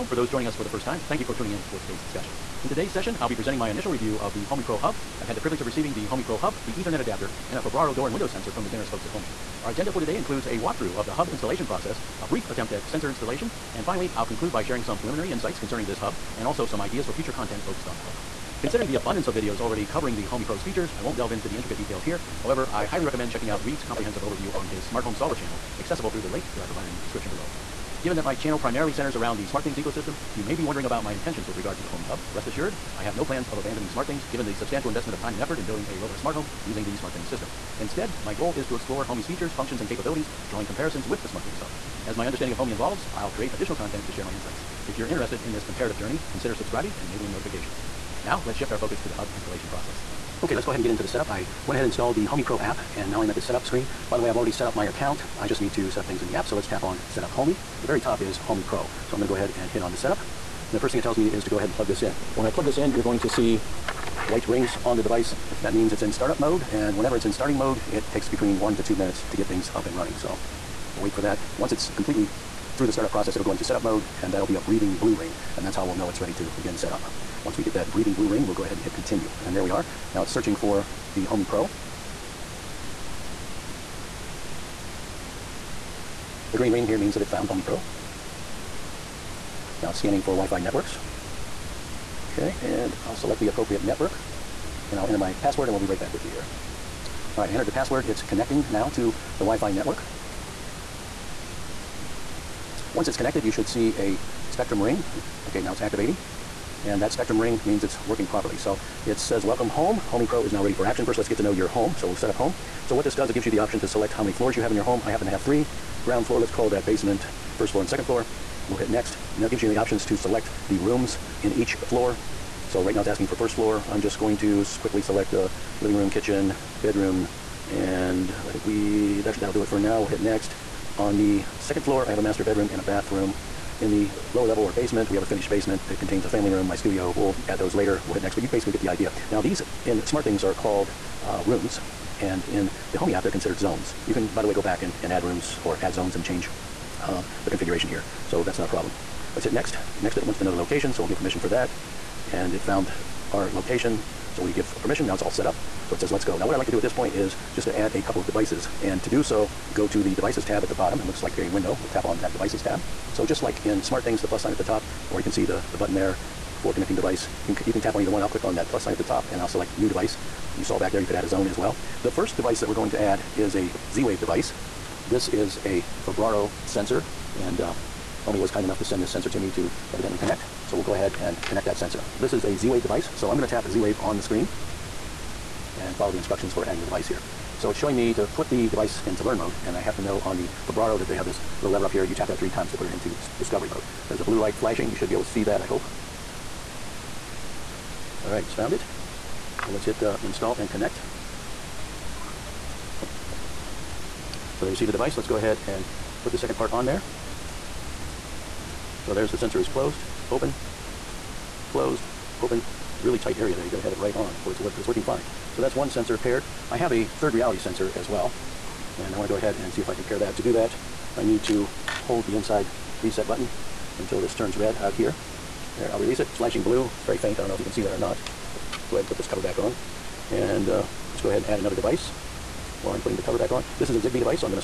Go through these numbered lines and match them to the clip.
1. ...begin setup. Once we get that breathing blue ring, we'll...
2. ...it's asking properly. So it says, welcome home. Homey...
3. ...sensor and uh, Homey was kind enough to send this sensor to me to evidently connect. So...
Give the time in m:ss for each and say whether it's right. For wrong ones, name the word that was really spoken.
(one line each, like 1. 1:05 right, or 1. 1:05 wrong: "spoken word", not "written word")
1. 1:16 right
2. 1:47 wrong: "working", not "asking"
3. 2:56 right.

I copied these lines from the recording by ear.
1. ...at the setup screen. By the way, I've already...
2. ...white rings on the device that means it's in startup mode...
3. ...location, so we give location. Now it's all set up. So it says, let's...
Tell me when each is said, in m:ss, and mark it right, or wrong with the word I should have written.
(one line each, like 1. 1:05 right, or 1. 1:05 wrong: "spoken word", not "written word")
1. 0:53 right
2. 1:04 right
3. 2:33 wrong: "permission", not "location".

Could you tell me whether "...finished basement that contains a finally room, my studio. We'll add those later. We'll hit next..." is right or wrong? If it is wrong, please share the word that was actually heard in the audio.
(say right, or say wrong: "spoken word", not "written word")
wrong: "family", not "finally".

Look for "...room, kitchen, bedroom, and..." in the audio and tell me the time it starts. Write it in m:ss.
2:05.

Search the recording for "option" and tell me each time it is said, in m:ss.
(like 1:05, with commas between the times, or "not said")
1:53, 1:59.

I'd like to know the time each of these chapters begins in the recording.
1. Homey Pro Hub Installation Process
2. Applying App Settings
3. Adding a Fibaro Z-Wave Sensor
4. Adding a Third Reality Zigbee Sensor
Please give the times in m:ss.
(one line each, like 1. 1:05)
1. 0:47
2. 1:51
3. 2:38
4. 3:36.